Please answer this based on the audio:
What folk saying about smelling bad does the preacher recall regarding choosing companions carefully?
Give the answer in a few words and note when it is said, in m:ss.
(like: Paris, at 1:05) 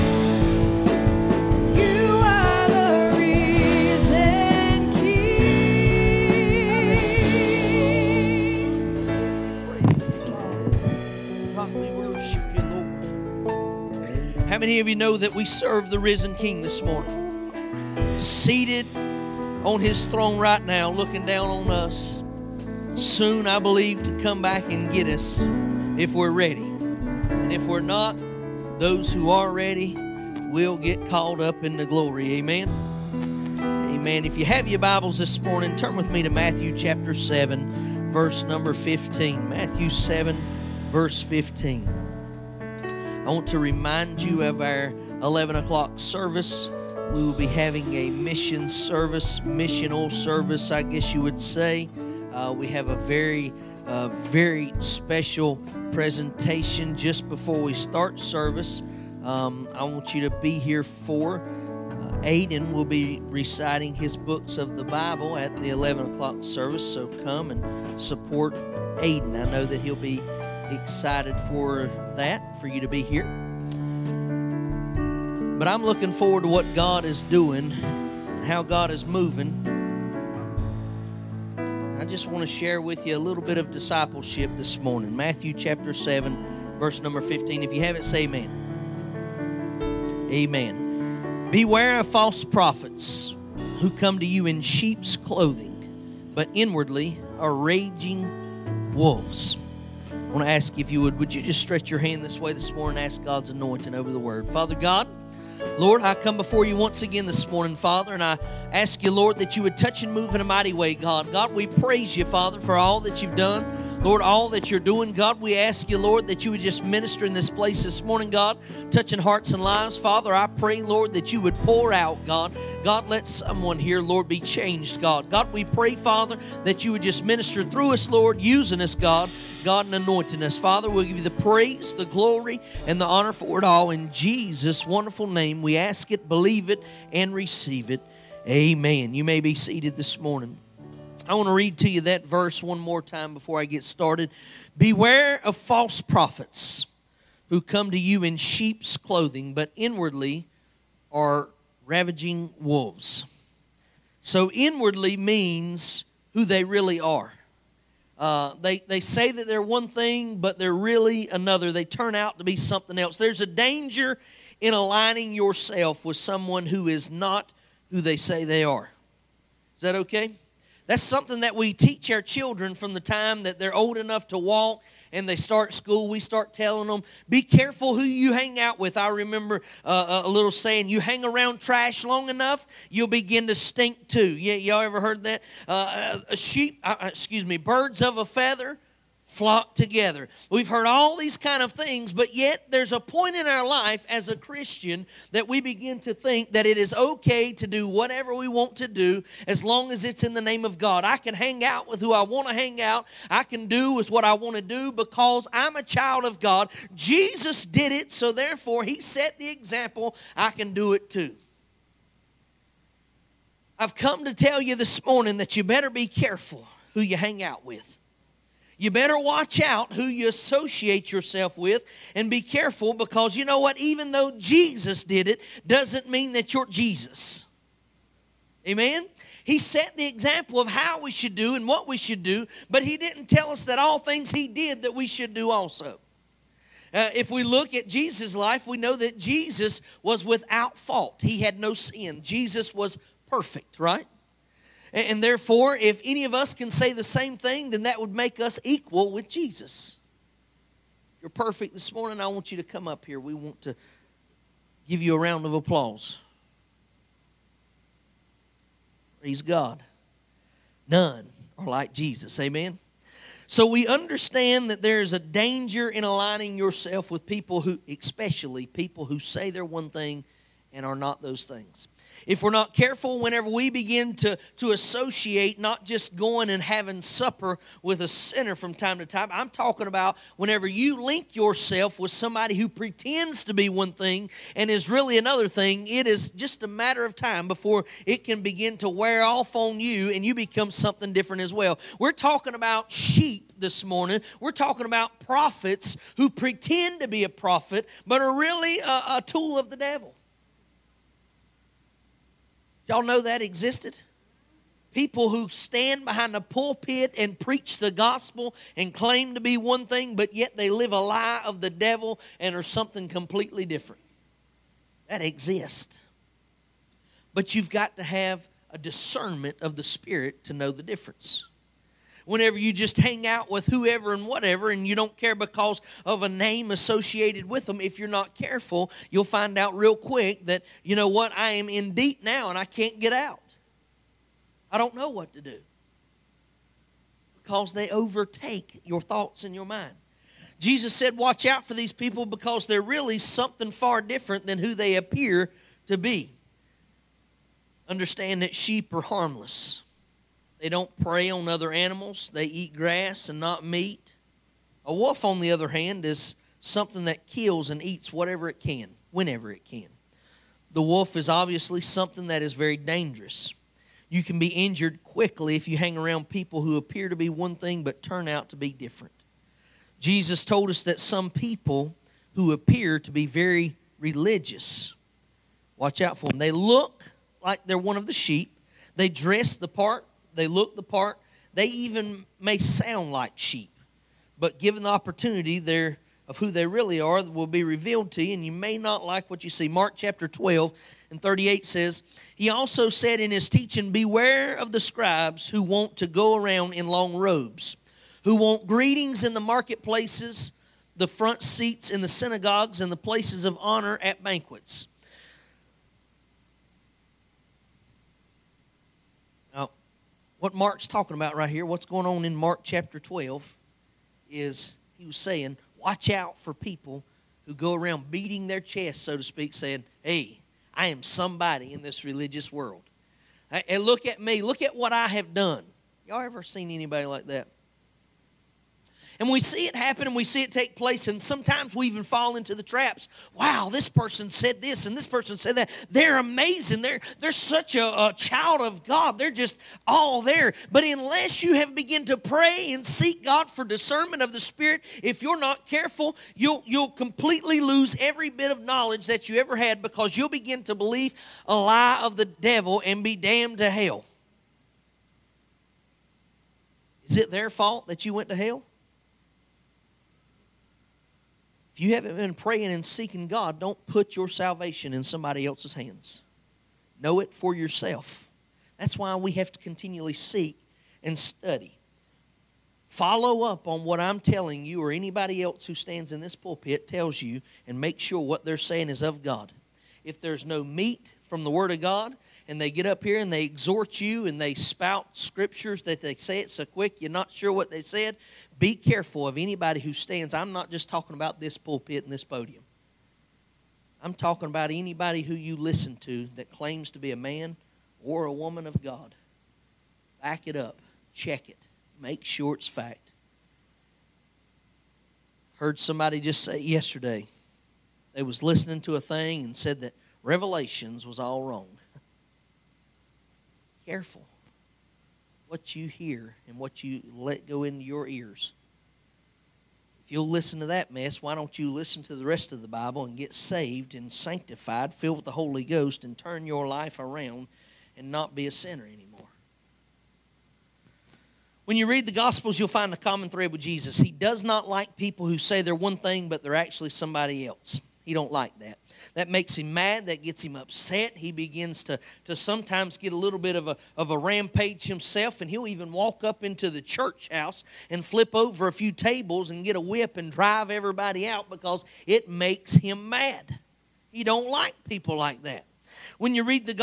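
you'll begin to stink too, at 3:02.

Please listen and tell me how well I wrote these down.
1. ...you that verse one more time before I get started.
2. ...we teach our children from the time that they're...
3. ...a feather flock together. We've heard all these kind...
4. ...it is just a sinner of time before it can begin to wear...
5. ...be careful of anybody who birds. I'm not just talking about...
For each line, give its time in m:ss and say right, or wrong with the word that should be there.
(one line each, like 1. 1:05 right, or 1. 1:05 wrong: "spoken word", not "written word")
1. 2:21 right
2. 2:51 right
3. 3:08 right
4. 4:45 wrong: "matter", not "sinner"
5. 8:08 wrong: "stands", not "birds".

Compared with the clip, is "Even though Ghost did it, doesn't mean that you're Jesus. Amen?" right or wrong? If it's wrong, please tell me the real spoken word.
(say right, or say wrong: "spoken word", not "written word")
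wrong: "Jesus", not "Ghost".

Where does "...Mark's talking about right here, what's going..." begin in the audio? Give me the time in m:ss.
6:50.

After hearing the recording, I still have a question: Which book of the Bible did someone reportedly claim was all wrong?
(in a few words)
Revelations.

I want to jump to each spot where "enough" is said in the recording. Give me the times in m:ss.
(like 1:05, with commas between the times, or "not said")
2:53, 3:02.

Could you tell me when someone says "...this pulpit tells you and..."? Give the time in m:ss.
7:56.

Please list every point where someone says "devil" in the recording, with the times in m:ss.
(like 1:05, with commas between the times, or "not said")
4:59, 5:11, 7:32.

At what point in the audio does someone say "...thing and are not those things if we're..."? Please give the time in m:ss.
4:29.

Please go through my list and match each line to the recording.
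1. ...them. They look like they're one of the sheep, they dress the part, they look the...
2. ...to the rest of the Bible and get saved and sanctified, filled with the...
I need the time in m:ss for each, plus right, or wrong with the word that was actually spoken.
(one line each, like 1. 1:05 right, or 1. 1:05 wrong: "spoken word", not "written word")
1. 6:16 right
2. 8:42 right.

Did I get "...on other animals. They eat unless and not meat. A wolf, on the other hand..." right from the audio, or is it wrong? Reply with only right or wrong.
wrong.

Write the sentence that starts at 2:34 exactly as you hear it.
So, inwardly means who they really are.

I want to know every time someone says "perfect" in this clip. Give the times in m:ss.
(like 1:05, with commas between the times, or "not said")
4:03, 4:11.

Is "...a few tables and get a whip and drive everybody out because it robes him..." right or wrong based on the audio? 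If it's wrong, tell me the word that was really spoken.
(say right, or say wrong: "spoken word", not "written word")
wrong: "makes", not "robes".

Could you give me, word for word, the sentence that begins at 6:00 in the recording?
The wolf is obviously something that is very dangerous.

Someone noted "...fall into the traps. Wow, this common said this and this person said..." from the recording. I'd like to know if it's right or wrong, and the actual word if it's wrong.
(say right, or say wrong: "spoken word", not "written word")
wrong: "person", not "common".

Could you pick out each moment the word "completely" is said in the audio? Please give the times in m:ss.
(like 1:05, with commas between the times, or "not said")
5:13, 7:26.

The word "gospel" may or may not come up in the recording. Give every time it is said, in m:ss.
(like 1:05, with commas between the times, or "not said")
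5:07, 8:52.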